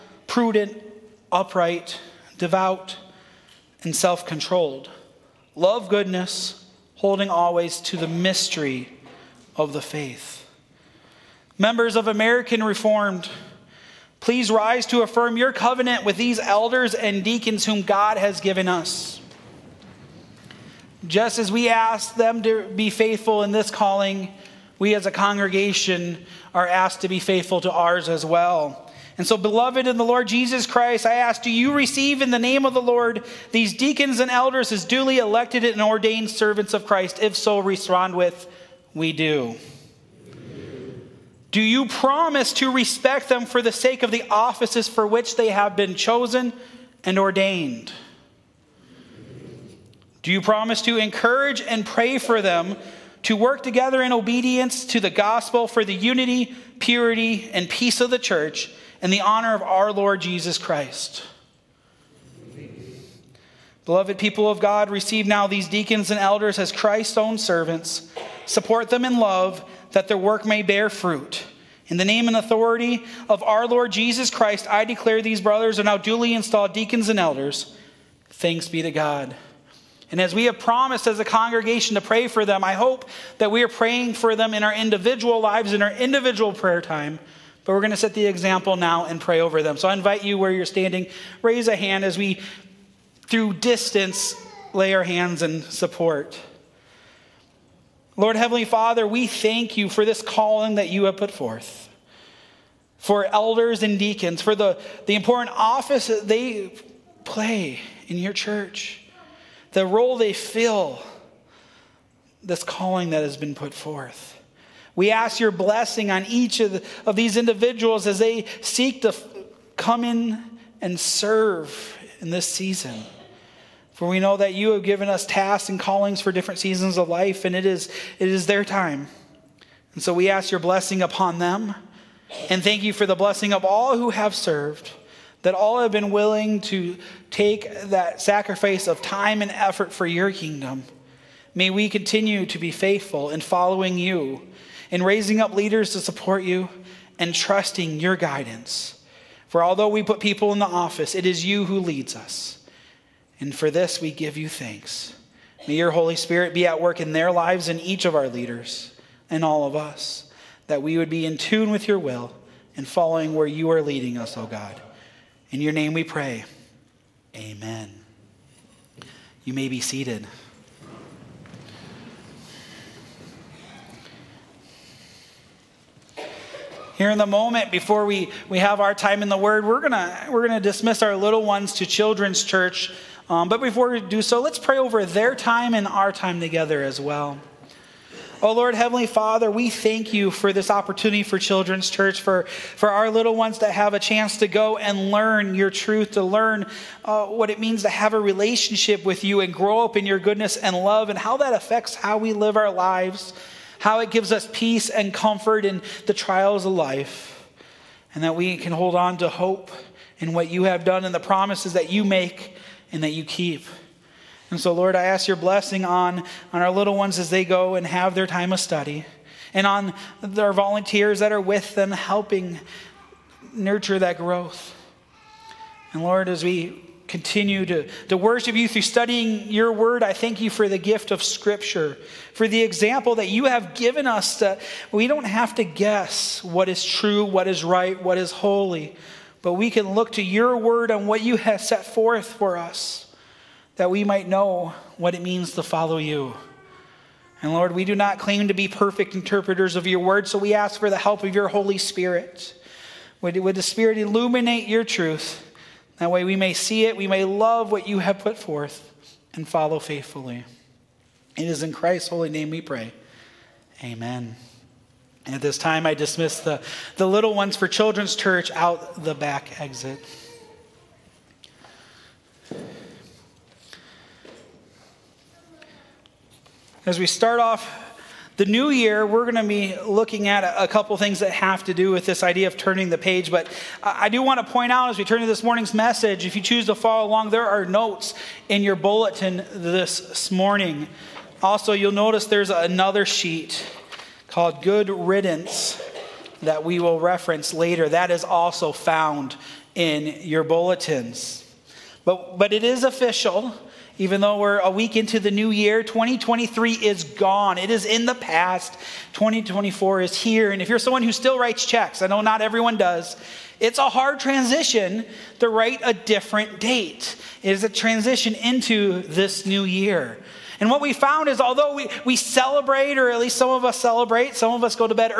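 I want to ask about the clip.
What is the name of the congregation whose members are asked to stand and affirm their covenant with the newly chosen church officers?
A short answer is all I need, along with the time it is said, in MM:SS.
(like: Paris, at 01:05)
American Reformed, at 00:12.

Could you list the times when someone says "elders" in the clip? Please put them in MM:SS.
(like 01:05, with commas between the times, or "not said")
00:16, 00:34, 01:06, 01:17, 01:43.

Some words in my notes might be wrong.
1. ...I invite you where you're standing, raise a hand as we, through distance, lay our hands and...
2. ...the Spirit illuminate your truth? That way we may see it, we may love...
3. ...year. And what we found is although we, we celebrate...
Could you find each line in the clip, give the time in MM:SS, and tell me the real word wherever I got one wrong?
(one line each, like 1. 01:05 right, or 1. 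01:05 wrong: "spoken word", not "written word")
1. 01:29 right
2. 04:13 right
3. 05:19 right.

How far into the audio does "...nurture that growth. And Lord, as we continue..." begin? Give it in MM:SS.
03:43.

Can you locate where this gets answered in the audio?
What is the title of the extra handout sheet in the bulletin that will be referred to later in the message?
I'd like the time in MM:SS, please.
04:54.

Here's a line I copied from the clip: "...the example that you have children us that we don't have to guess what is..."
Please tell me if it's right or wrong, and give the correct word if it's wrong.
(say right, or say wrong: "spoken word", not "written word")
wrong: "given", not "children".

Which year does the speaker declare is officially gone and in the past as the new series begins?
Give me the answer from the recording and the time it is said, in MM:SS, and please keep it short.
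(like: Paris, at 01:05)
2023, at 05:05.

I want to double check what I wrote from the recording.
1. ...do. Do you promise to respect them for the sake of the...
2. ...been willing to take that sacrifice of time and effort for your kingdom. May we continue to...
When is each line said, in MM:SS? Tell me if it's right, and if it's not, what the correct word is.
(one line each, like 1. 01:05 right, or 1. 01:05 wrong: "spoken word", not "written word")
1. 00:39 right
2. 02:15 right.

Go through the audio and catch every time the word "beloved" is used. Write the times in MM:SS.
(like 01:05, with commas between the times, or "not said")
00:29, 01:03.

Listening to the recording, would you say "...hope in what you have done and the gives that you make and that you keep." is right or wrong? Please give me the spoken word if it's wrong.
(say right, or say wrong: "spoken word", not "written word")
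wrong: "promises", not "gives".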